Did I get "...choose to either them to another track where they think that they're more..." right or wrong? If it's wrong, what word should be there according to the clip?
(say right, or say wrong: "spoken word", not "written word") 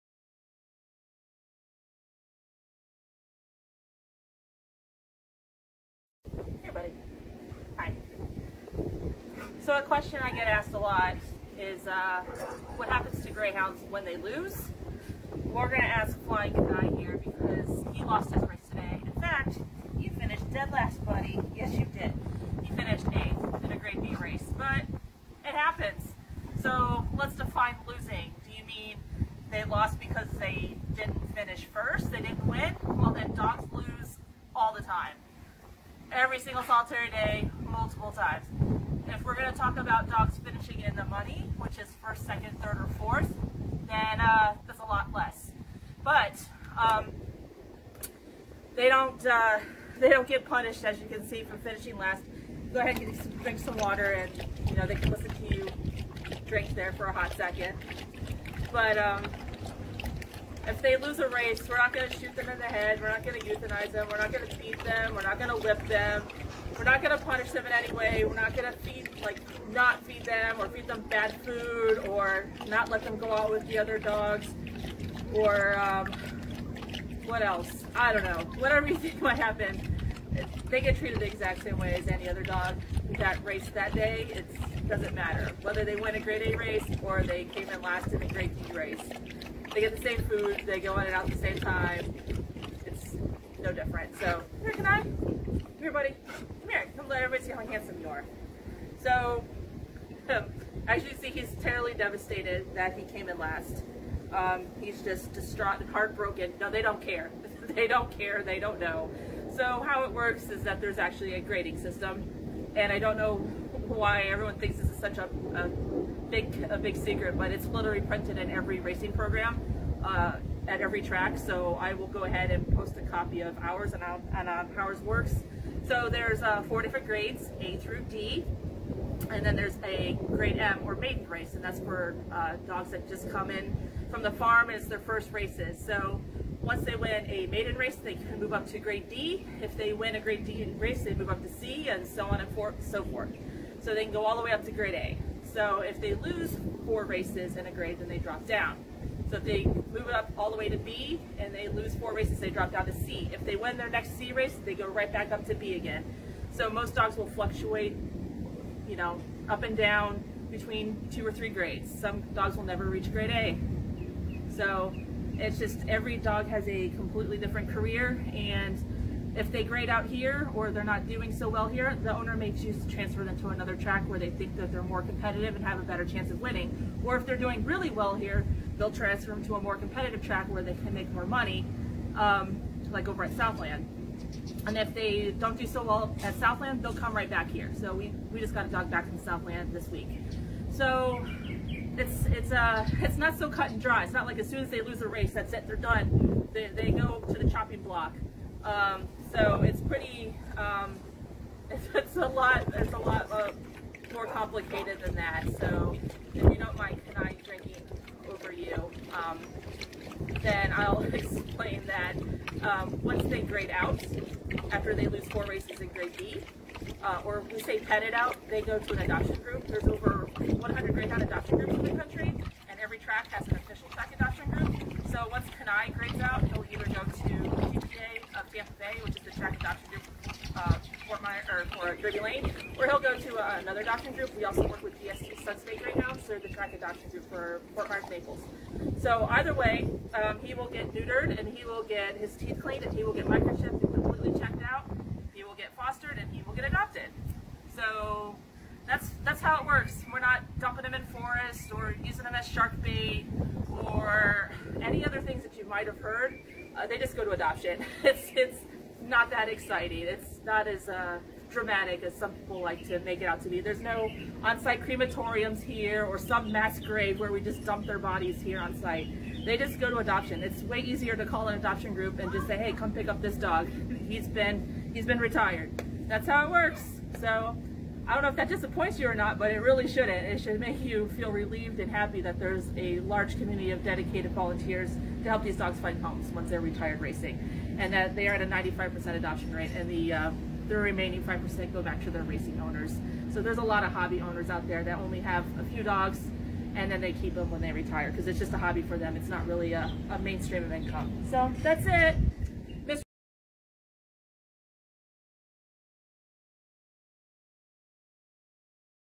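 wrong: "transfer", not "either".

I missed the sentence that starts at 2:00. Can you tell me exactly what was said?
Uh, at every track, so I will go ahead and post a copy of ours and on, and on Powers Works.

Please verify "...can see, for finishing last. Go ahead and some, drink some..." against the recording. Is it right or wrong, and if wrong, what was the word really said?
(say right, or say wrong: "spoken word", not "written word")
right.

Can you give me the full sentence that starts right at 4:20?
It's not as uh, dramatic as some people like to make it out to be.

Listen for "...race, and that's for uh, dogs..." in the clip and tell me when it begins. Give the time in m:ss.
2:11.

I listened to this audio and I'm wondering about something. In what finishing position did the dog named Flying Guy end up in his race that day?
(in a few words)
8th.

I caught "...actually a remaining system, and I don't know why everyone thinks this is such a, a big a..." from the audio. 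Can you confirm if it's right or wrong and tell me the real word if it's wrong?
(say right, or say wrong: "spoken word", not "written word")
wrong: "grading", not "remaining".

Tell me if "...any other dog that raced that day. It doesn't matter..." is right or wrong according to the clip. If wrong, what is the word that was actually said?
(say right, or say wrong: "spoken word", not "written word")
right.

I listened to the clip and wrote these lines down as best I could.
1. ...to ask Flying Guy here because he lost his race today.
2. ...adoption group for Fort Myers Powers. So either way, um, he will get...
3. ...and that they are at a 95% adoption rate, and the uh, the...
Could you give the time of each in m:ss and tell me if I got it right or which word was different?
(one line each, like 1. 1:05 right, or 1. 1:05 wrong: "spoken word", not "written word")
1. 0:15 right
2. 3:56 wrong: "Naples", not "Powers"
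3. 4:47 right.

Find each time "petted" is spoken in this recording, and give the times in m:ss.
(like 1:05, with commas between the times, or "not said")
3:37.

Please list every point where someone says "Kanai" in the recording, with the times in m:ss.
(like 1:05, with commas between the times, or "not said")
3:27, 3:45.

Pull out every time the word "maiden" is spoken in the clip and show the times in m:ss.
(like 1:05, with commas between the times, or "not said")
2:10, 2:17.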